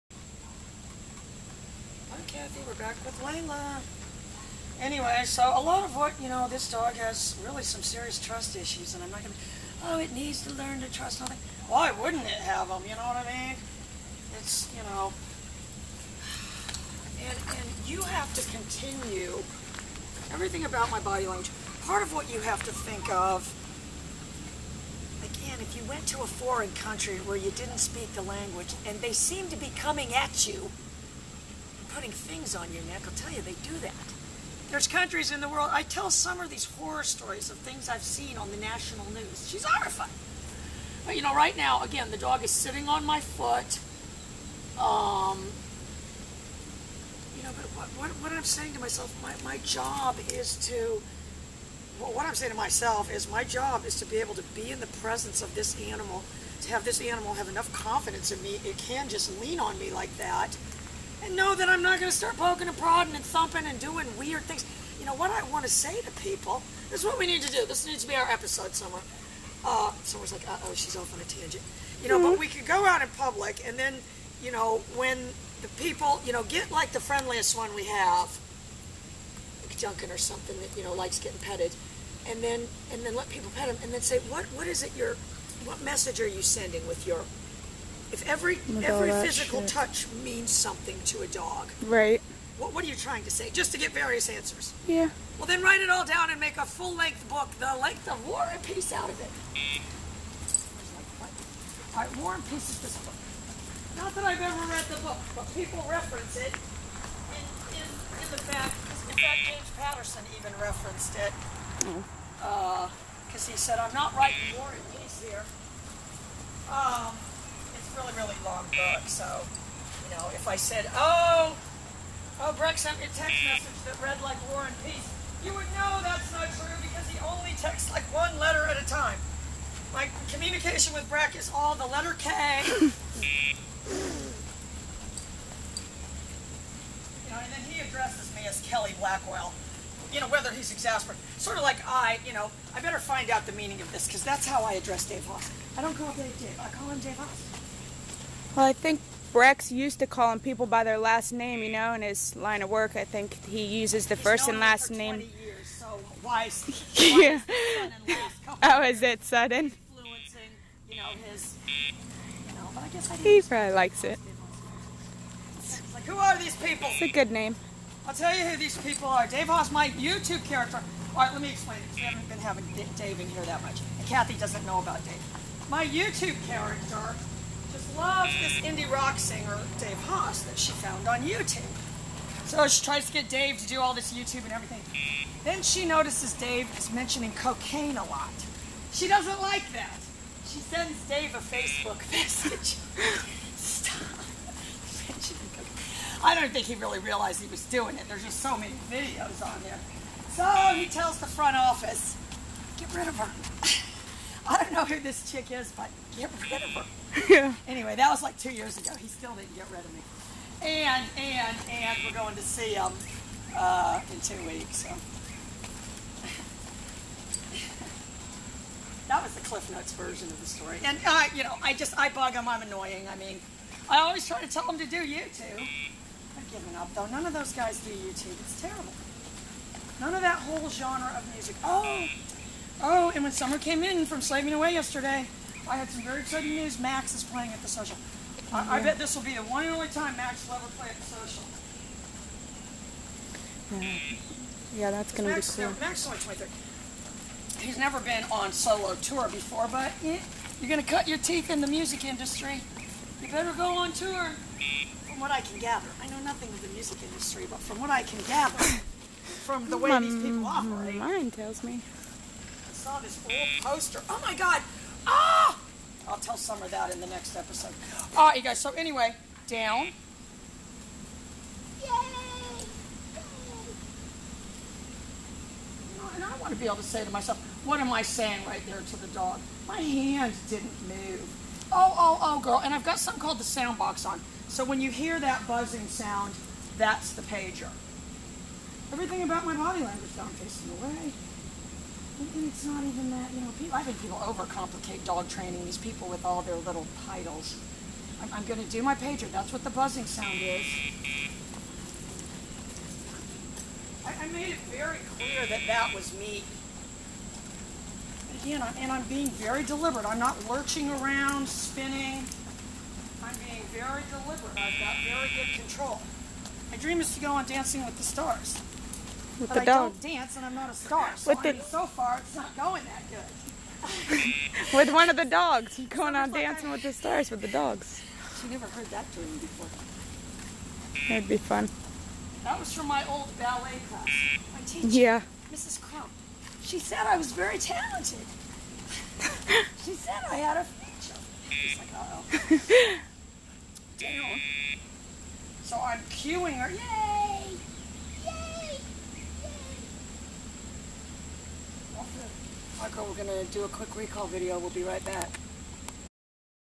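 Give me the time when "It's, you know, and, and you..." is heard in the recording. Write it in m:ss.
0:14.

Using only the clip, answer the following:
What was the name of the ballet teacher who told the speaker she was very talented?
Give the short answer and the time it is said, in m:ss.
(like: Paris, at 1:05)
Mrs. Crump, at 5:35.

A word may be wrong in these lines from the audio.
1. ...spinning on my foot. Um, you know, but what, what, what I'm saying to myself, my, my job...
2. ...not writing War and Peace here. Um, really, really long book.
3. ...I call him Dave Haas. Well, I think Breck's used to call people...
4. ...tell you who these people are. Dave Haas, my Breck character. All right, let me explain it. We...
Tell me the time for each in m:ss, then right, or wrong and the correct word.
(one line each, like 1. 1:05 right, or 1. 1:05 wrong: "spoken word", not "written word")
1. 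0:42 wrong: "sitting", not "spinning"
2. 1:53 right
3. 2:26 right
4. 2:48 wrong: "YouTube", not "Breck".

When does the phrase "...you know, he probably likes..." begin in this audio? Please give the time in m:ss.
2:41.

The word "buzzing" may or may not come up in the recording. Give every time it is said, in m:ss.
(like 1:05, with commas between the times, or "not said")
4:45, 4:59.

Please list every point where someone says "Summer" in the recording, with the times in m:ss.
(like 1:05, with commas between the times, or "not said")
0:36, 3:53, 4:26.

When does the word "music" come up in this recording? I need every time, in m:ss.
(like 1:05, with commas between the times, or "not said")
3:51, 4:11, 4:16.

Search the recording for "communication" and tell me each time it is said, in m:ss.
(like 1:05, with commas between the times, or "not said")
2:10.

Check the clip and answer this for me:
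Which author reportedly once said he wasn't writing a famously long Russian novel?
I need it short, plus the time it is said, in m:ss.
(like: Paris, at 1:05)
James Patterson, at 1:49.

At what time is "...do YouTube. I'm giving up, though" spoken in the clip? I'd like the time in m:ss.
3:44.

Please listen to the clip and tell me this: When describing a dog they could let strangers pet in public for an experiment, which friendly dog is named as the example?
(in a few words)
Duncan.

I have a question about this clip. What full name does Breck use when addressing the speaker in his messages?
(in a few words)
Kelly Blackwell.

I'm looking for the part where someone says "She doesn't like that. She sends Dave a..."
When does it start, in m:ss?
3:08.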